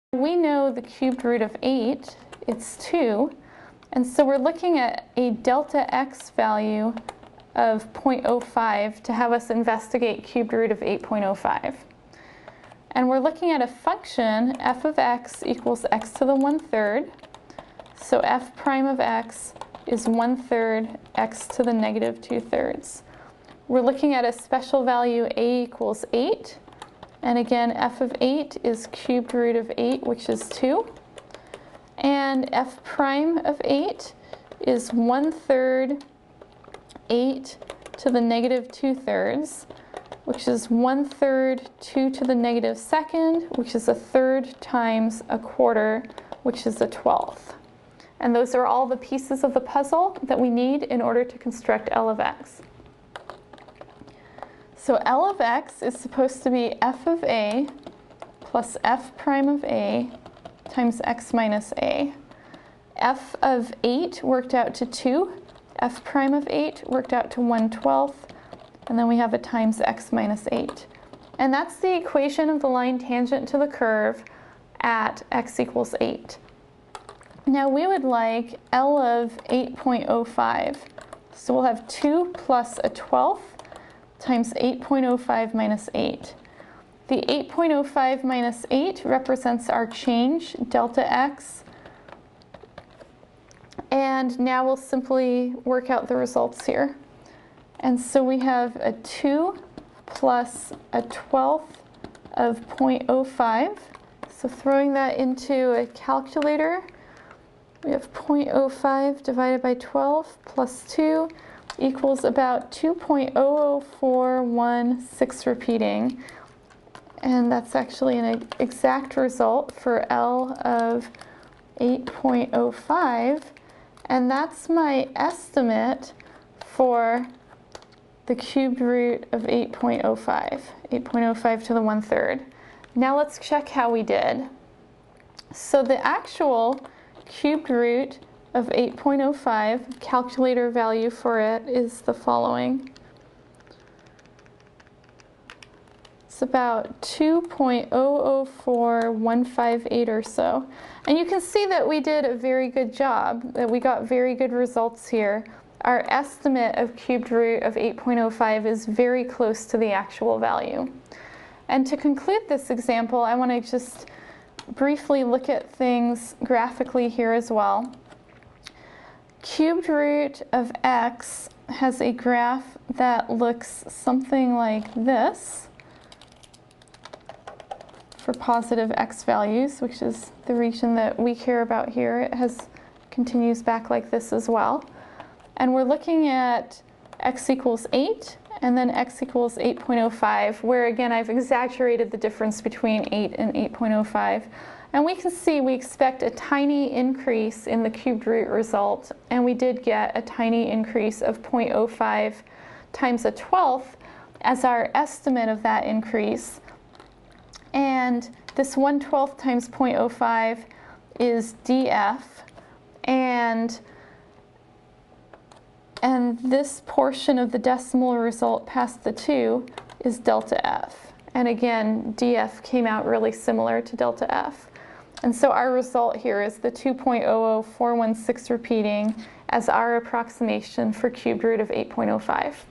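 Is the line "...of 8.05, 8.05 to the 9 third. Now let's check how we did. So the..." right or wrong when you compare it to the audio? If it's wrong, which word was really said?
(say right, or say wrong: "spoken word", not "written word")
wrong: "1", not "9".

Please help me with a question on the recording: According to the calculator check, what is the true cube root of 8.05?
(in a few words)
2.004158.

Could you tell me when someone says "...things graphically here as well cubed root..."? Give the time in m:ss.
2:45.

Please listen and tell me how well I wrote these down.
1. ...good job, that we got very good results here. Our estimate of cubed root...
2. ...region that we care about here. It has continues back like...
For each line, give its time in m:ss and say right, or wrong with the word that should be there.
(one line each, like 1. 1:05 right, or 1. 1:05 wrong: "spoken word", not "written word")
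1. 2:32 right
2. 3:00 right.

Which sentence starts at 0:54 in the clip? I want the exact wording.
So L of x is supposed to be f of a plus f prime of a times x minus a.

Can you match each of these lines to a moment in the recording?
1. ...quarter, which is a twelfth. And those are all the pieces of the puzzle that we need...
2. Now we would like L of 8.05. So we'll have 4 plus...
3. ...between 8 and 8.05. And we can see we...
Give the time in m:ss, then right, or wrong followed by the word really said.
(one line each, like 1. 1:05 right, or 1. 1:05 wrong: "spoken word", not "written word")
1. 0:45 right
2. 1:17 wrong: "2", not "4"
3. 3:12 right.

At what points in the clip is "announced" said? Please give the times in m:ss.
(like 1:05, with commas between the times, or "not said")
not said.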